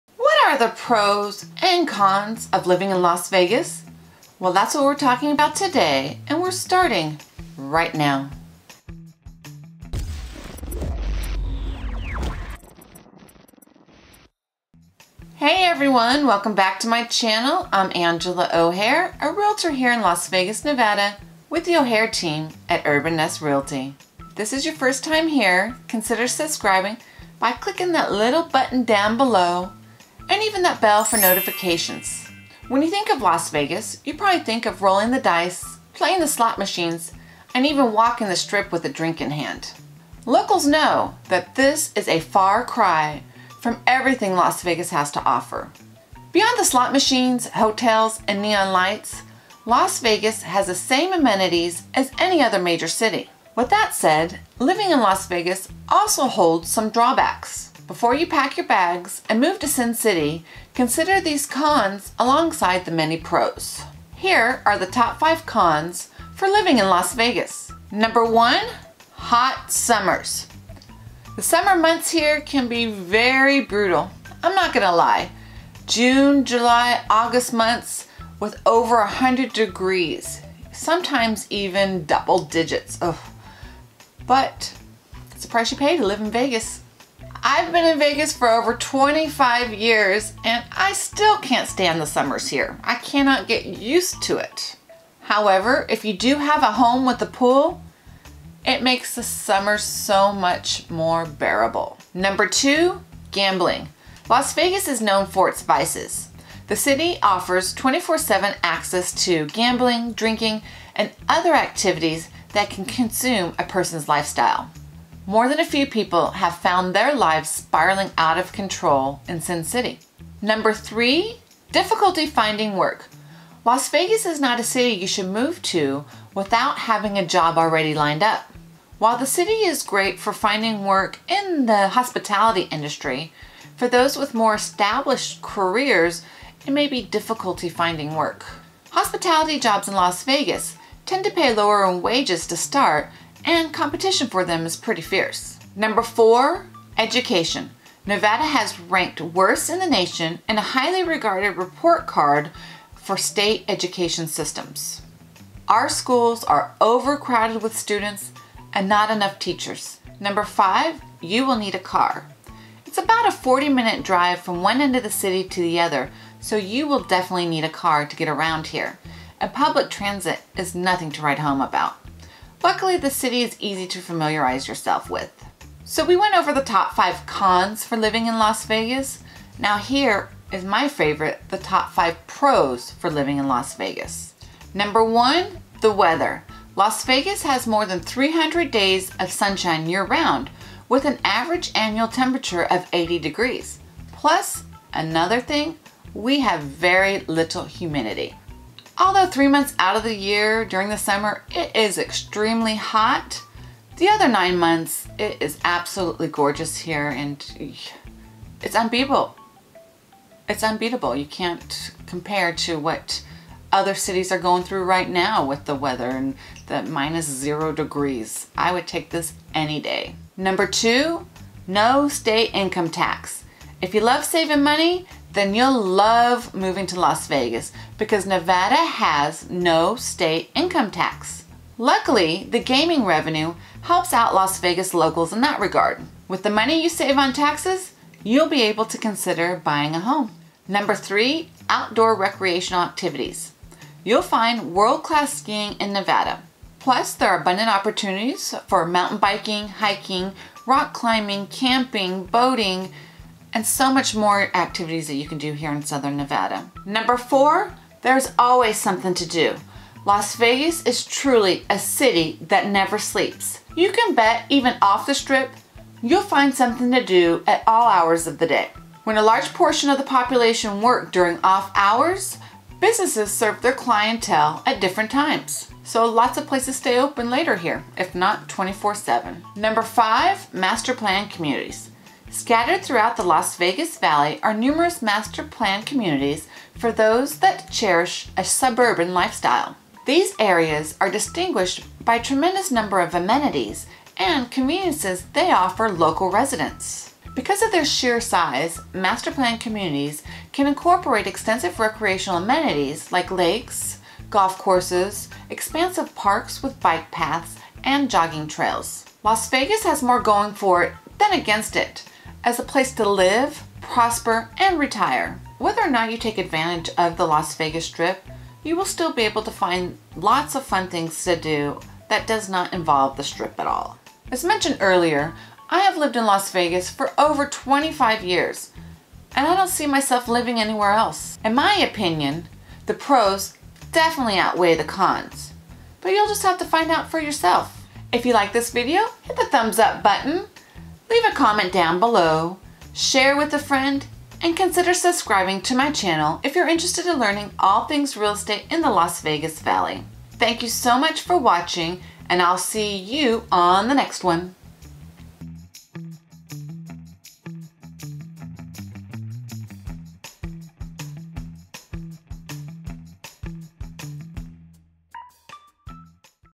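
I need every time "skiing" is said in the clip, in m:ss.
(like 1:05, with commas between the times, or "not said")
4:05.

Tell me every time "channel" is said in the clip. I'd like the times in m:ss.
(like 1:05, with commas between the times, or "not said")
0:17, 5:45.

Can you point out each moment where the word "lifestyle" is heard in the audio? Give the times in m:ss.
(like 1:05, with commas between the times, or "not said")
1:54, 4:49.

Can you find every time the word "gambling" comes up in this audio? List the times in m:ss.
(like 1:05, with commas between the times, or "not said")
1:43, 1:49.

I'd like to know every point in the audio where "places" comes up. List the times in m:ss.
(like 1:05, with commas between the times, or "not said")
4:36, 5:12.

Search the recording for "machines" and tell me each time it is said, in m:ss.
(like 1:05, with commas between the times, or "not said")
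0:36, 0:46.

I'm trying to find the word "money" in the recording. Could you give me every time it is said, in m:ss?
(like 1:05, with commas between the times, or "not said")
3:44, 3:56.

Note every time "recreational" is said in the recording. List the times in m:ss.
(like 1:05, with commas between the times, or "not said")
4:02, 5:01.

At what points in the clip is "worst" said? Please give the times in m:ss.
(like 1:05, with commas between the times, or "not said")
2:29.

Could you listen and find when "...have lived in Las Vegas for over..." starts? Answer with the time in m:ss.
5:25.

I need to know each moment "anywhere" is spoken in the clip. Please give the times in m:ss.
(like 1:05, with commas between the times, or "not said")
5:30.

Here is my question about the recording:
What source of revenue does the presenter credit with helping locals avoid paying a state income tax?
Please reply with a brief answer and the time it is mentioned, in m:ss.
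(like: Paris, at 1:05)
gaming revenue, at 3:52.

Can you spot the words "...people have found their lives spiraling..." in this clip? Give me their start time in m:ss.
1:55.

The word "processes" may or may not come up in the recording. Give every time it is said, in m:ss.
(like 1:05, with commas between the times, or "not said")
not said.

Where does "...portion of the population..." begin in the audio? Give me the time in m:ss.
4:29.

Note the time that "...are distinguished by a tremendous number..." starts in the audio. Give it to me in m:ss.
4:51.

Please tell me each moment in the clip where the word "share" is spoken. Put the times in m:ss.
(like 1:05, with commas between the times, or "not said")
5:42.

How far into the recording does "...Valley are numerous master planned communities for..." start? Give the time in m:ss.
4:43.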